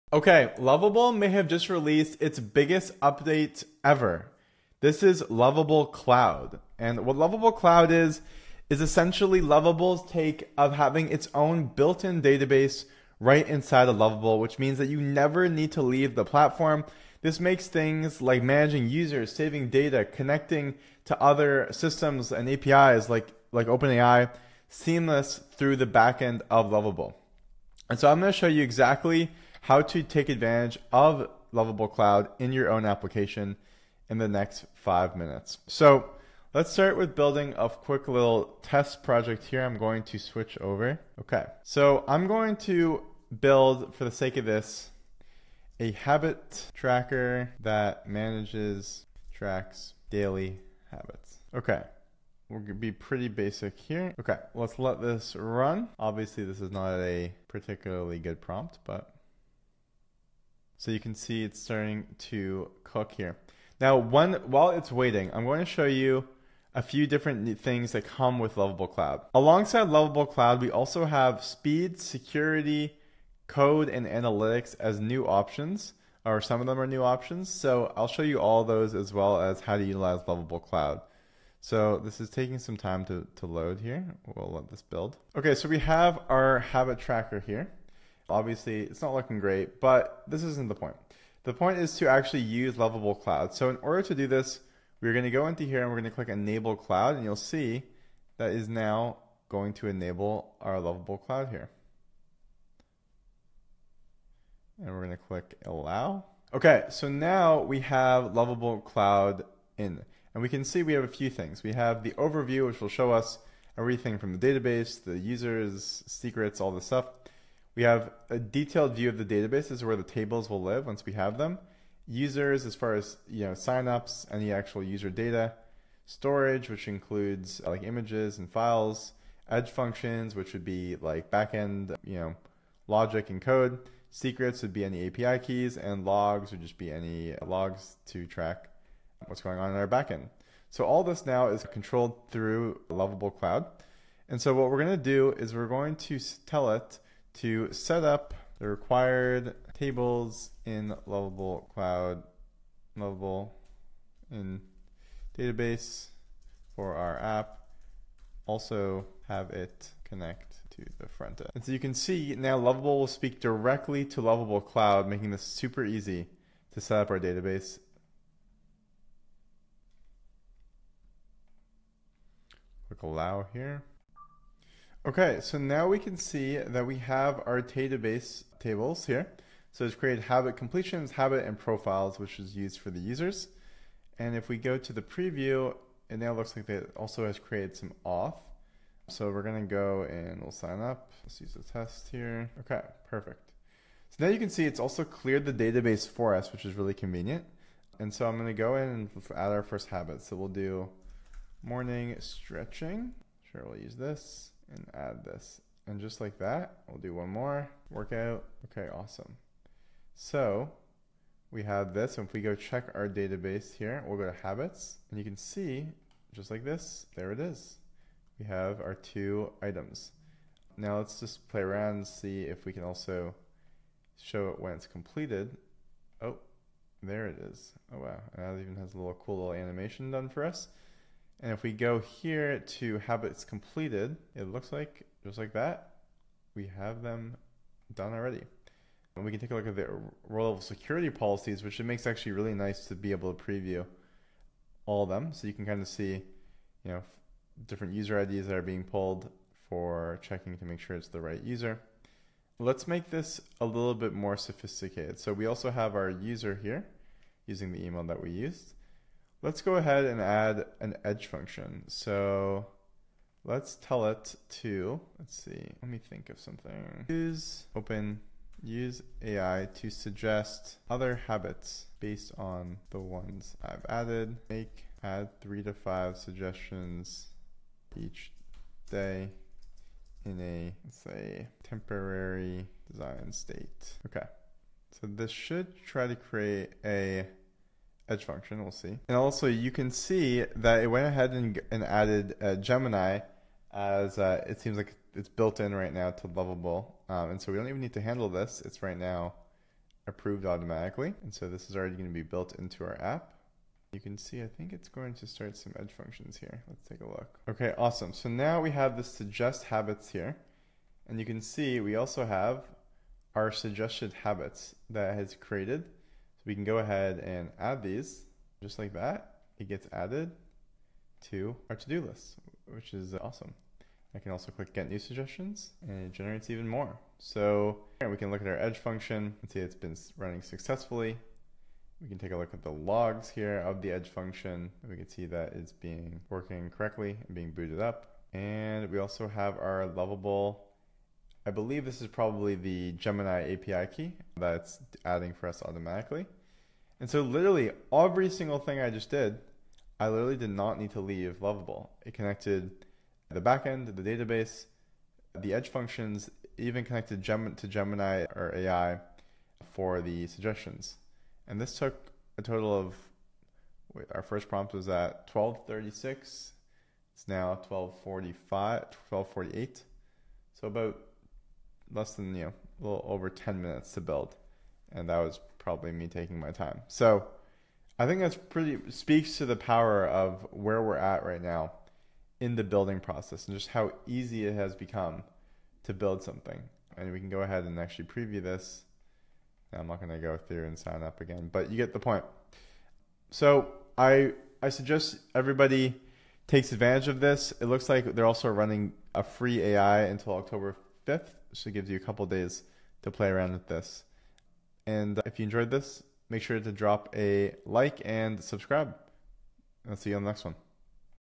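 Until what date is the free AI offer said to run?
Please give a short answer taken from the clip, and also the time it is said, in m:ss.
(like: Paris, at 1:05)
October 5th, at 6:40.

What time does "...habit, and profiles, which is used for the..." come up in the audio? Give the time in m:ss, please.
3:01.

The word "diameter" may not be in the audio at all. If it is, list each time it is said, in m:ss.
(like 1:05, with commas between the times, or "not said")
not said.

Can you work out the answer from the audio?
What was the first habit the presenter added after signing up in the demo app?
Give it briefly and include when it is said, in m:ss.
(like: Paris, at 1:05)
Morning stretching, at 3:21.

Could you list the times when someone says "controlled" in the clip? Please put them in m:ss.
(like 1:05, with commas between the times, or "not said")
2:21.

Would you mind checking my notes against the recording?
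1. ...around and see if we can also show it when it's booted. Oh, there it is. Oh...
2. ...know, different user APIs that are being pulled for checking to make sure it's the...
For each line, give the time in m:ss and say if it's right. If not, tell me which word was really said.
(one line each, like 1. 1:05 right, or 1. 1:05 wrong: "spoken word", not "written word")
1. 3:41 wrong: "completed", not "booted"
2. 4:06 wrong: "IDs", not "APIs".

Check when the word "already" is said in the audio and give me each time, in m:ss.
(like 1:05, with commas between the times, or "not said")
3:58, 5:01.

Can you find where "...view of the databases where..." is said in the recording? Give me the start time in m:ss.
1:58.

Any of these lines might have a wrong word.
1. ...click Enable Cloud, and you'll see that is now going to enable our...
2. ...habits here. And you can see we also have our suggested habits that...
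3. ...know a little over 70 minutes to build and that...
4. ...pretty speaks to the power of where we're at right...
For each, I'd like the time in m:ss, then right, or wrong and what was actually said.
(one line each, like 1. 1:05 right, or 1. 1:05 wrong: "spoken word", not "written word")
1. 1:36 right
2. 5:09 right
3. 6:12 wrong: "10", not "70"
4. 6:18 right.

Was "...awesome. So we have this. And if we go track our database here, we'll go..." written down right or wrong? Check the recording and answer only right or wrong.
wrong.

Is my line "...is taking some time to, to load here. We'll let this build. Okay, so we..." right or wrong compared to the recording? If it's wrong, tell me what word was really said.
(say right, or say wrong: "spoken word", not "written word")
right.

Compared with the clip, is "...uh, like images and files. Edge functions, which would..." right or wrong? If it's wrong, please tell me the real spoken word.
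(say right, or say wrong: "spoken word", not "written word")
right.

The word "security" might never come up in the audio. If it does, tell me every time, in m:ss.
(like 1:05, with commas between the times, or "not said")
1:11, 4:00.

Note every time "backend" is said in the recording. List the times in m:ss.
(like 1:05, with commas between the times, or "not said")
0:25, 2:11, 2:19, 5:53.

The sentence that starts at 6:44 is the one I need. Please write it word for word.
And uh, if you enjoyed this, make sure to drop a like and subscribe.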